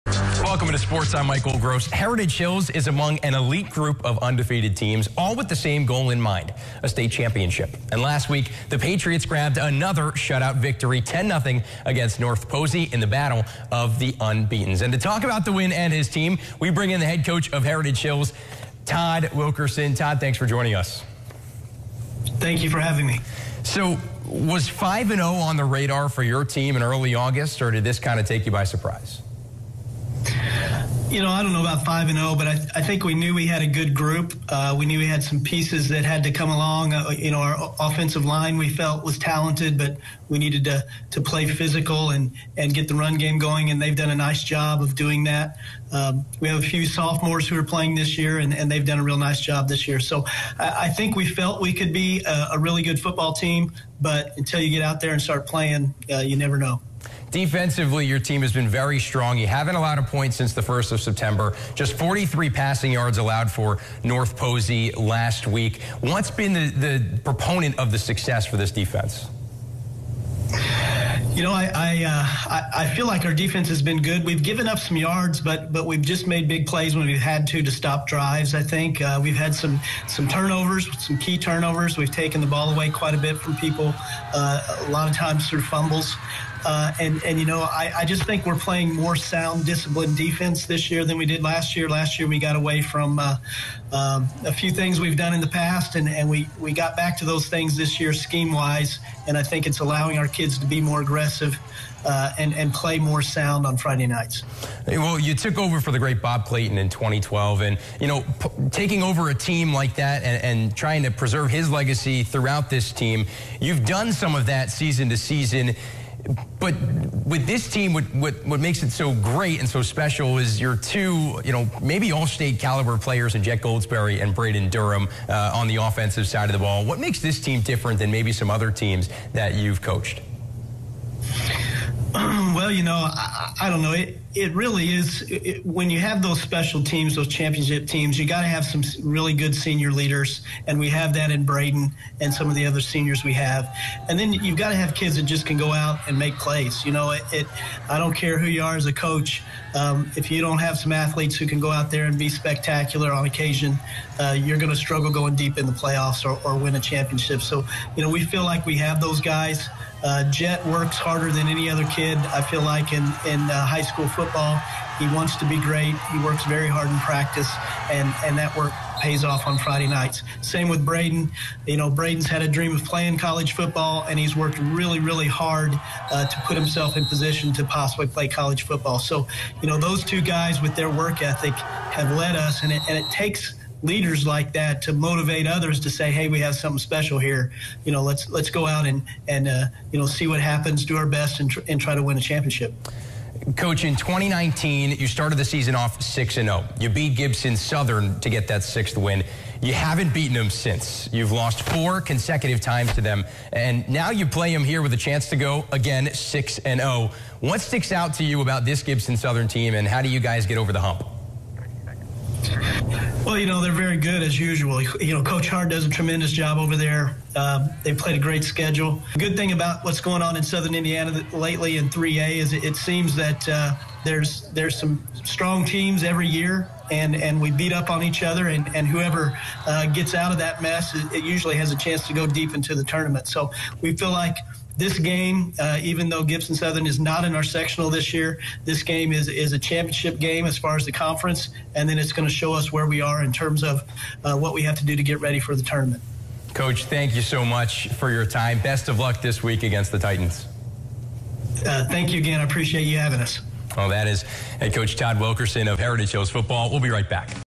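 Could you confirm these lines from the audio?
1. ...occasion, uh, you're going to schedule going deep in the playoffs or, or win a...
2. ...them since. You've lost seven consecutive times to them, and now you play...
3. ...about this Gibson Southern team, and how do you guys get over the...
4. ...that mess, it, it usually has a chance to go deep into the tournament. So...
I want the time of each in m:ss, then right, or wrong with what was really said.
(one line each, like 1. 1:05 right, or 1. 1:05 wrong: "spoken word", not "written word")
1. 2:33 wrong: "struggle", not "schedule"
2. 3:20 wrong: "four", not "seven"
3. 3:28 right
4. 3:50 right.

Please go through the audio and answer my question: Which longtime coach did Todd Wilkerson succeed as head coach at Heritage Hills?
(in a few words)
Bob Clayton.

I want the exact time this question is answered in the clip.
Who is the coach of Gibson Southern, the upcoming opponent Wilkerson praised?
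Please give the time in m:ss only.
3:35.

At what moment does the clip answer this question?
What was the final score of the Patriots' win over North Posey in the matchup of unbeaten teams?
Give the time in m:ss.
0:11.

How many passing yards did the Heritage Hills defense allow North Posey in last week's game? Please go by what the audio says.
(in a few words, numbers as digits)
43.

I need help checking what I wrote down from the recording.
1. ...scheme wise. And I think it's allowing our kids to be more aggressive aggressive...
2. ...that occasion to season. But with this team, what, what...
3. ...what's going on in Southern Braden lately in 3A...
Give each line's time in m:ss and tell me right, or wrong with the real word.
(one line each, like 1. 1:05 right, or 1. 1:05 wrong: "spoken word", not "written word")
1. 1:38 right
2. 1:54 wrong: "season", not "occasion"
3. 3:39 wrong: "Indiana", not "Braden".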